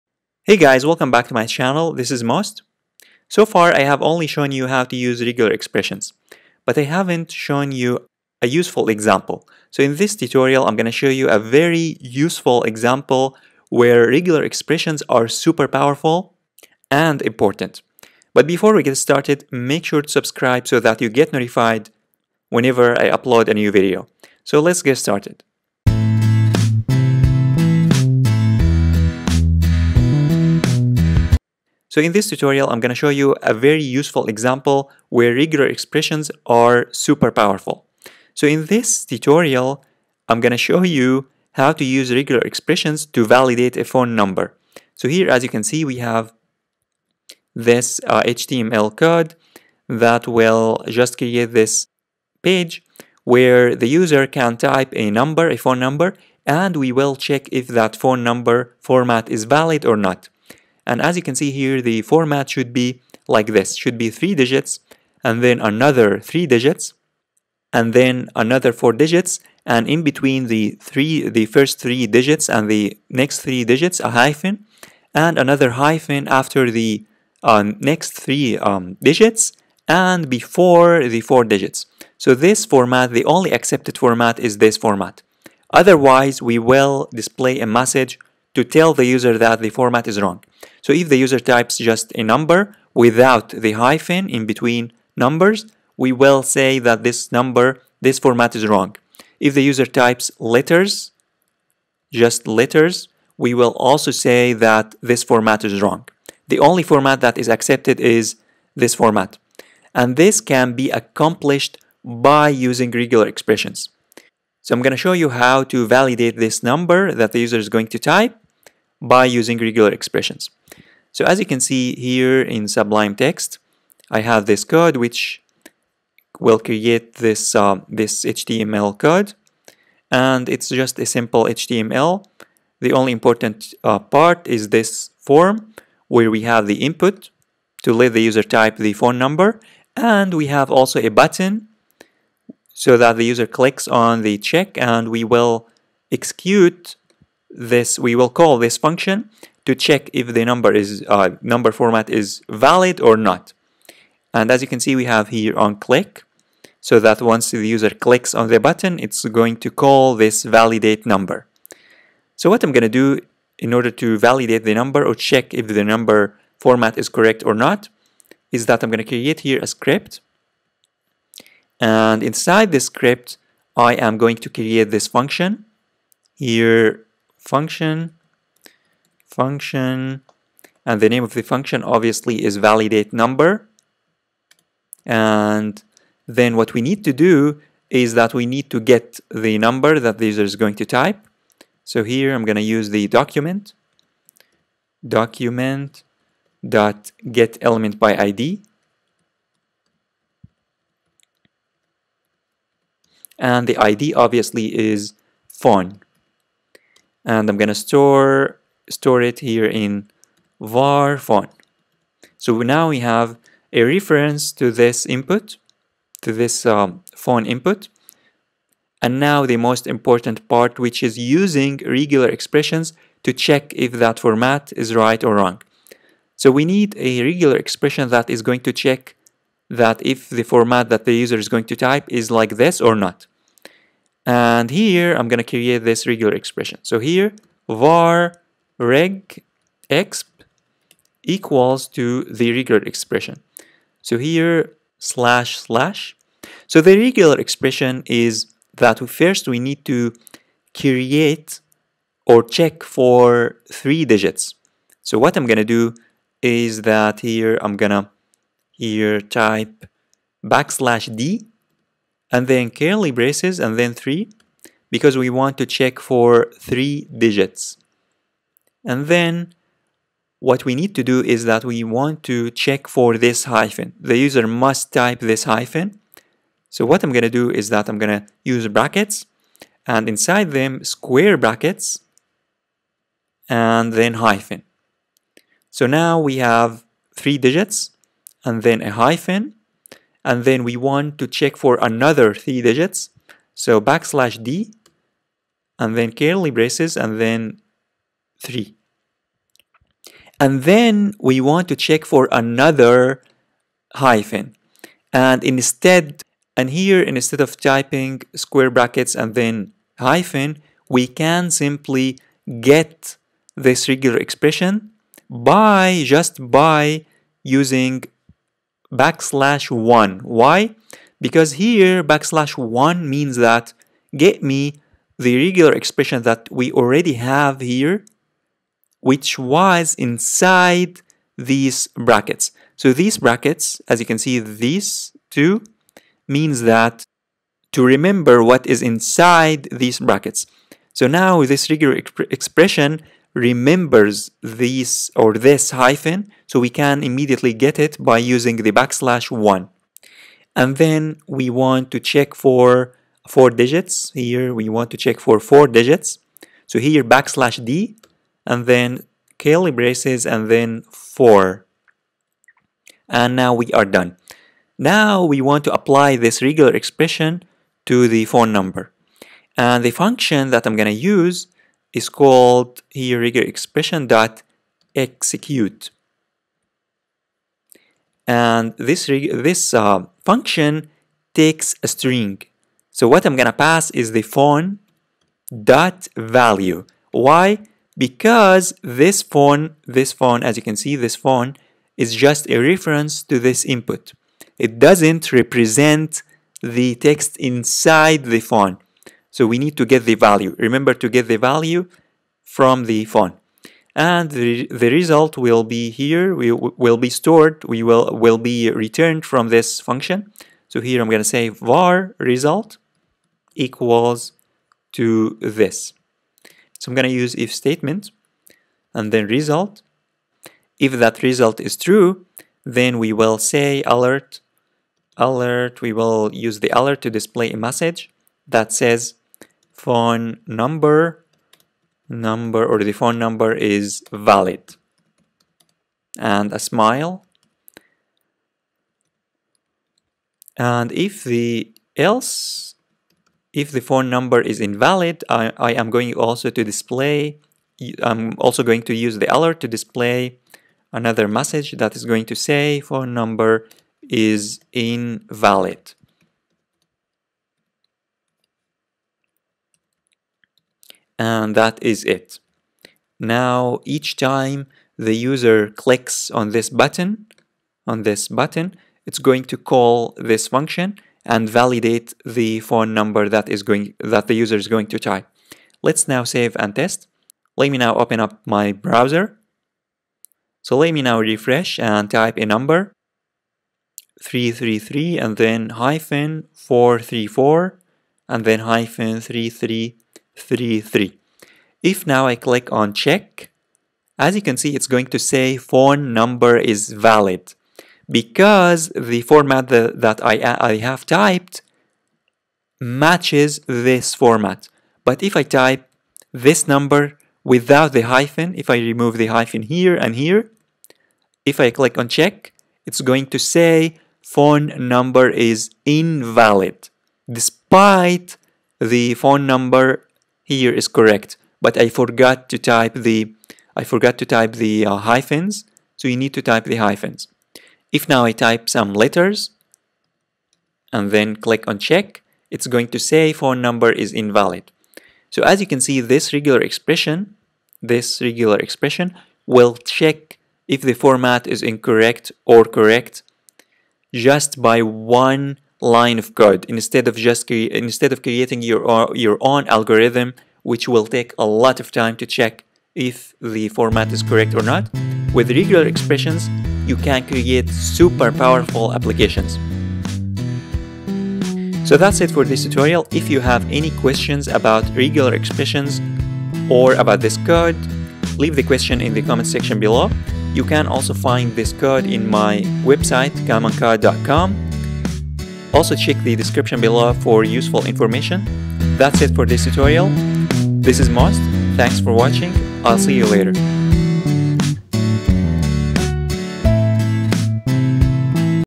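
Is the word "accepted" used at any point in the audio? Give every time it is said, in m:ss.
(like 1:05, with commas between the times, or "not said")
1:23, 1:47.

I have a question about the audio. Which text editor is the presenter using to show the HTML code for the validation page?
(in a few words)
Sublime Text.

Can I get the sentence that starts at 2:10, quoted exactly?
And it's just a simple HTML.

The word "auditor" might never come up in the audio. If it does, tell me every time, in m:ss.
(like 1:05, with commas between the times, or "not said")
not said.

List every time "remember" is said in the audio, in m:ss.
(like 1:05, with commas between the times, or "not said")
5:37, 5:43, 6:40.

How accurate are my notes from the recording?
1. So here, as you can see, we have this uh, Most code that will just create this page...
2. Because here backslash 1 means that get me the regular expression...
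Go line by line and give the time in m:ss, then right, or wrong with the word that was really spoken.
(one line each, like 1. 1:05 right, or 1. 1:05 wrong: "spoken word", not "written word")
1. 0:44 wrong: "HTML", not "Most"
2. 5:21 right.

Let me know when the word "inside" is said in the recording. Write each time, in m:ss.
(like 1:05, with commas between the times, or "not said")
2:52, 4:40, 5:29, 5:38, 6:37.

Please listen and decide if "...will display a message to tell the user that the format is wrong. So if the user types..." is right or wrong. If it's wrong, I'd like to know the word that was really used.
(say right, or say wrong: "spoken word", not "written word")
right.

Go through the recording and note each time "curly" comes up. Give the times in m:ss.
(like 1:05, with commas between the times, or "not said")
4:22, 4:56, 5:59.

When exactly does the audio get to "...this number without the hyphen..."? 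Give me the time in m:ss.
8:26.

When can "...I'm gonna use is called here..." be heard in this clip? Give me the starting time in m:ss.
6:10.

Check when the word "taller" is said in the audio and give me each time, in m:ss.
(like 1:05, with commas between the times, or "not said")
not said.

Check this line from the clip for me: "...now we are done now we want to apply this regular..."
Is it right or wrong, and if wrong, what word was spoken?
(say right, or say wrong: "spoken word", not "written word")
right.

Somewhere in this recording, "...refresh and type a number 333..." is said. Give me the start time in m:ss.
8:01.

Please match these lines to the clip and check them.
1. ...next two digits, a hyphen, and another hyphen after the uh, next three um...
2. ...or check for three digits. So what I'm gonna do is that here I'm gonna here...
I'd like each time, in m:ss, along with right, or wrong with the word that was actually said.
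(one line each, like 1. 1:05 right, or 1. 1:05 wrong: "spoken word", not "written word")
1. 1:13 wrong: "three", not "two"
2. 4:12 right.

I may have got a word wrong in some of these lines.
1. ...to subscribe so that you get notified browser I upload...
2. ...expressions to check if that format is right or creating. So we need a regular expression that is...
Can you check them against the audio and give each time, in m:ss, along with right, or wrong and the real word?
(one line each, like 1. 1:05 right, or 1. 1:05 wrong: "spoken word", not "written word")
1. 0:20 wrong: "whenever", not "browser"
2. 3:42 wrong: "wrong", not "creating".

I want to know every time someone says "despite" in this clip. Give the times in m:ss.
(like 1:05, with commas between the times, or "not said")
8:37.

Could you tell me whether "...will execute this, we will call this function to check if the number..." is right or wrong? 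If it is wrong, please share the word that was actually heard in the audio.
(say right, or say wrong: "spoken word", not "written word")
right.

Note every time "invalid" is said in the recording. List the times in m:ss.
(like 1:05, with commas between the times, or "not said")
7:24, 7:34, 8:35, 8:54.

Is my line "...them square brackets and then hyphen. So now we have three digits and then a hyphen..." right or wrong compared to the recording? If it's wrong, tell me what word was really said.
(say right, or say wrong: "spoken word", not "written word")
right.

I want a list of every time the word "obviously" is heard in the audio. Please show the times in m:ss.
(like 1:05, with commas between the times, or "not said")
3:01, 3:24.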